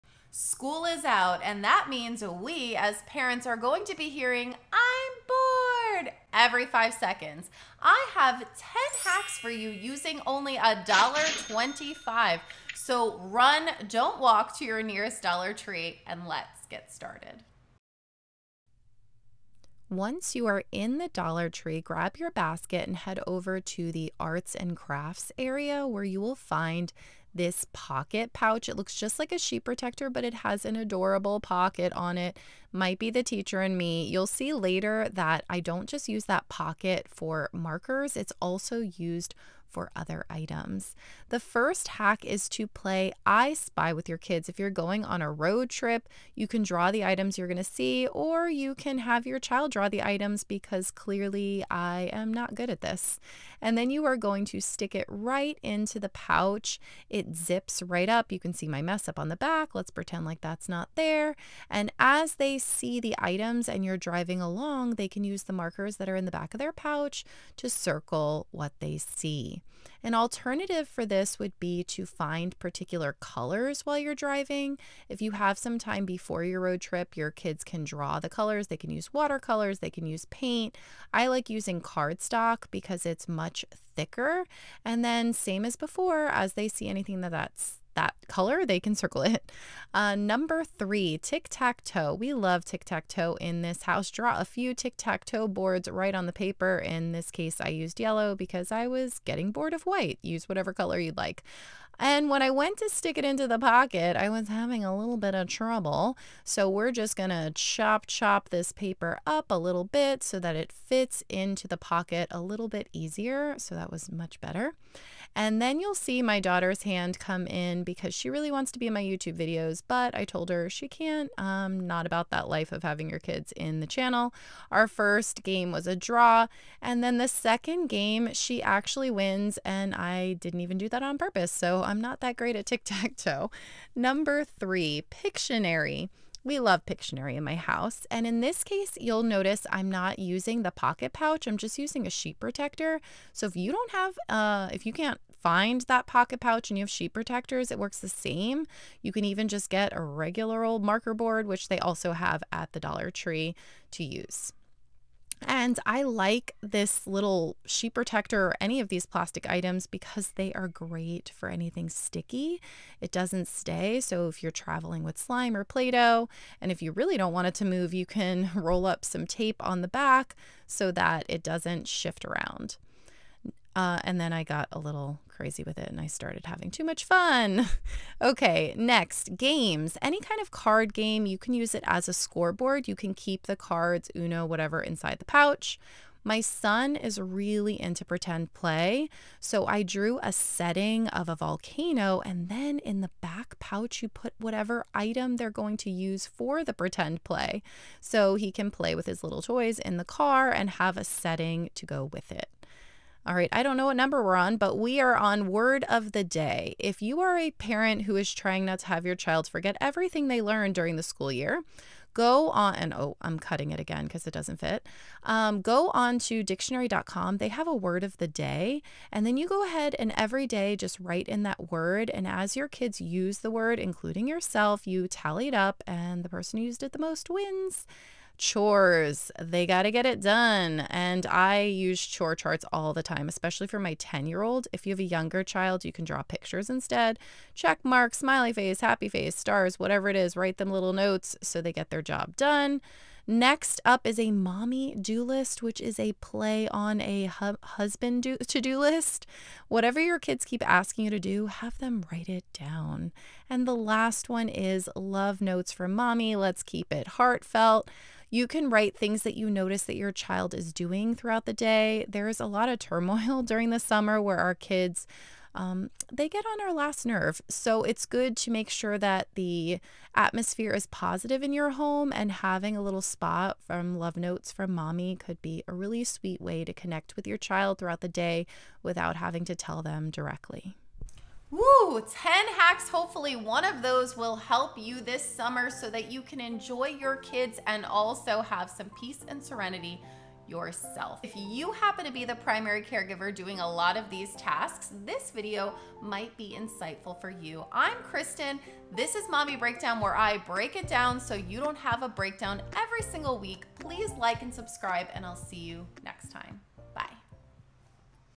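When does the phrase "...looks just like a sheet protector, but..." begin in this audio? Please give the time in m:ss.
0:28.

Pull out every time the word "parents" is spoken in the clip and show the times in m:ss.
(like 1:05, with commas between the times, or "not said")
0:03, 3:27.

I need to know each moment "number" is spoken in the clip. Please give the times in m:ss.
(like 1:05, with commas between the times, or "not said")
1:30, 2:13, 3:23.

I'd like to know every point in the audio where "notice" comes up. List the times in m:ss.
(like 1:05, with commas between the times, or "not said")
2:19, 4:19.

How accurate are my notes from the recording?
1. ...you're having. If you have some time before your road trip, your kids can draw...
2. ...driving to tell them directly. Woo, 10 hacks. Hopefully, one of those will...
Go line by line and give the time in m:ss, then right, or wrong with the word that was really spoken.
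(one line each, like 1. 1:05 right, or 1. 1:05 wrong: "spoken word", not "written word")
1. 1:13 wrong: "driving", not "having"
2. 4:39 wrong: "having", not "driving".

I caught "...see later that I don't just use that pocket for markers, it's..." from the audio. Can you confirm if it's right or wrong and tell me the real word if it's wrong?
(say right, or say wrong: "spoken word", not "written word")
right.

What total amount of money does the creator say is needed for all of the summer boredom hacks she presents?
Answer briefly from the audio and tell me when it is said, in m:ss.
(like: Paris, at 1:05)
$1.25, at 0:10.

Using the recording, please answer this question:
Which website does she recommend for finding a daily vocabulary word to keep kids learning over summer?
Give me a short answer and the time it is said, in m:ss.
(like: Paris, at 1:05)
dictionary.com, at 3:36.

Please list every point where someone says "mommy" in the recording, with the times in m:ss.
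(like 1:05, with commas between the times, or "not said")
4:04, 4:15, 4:34, 4:59.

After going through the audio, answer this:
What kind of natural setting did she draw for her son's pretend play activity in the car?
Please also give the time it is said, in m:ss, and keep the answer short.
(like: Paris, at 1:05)
A volcano, at 3:11.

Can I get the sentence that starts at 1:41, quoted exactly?
And when I went to stick it into the pocket, I was having a little bit of trouble.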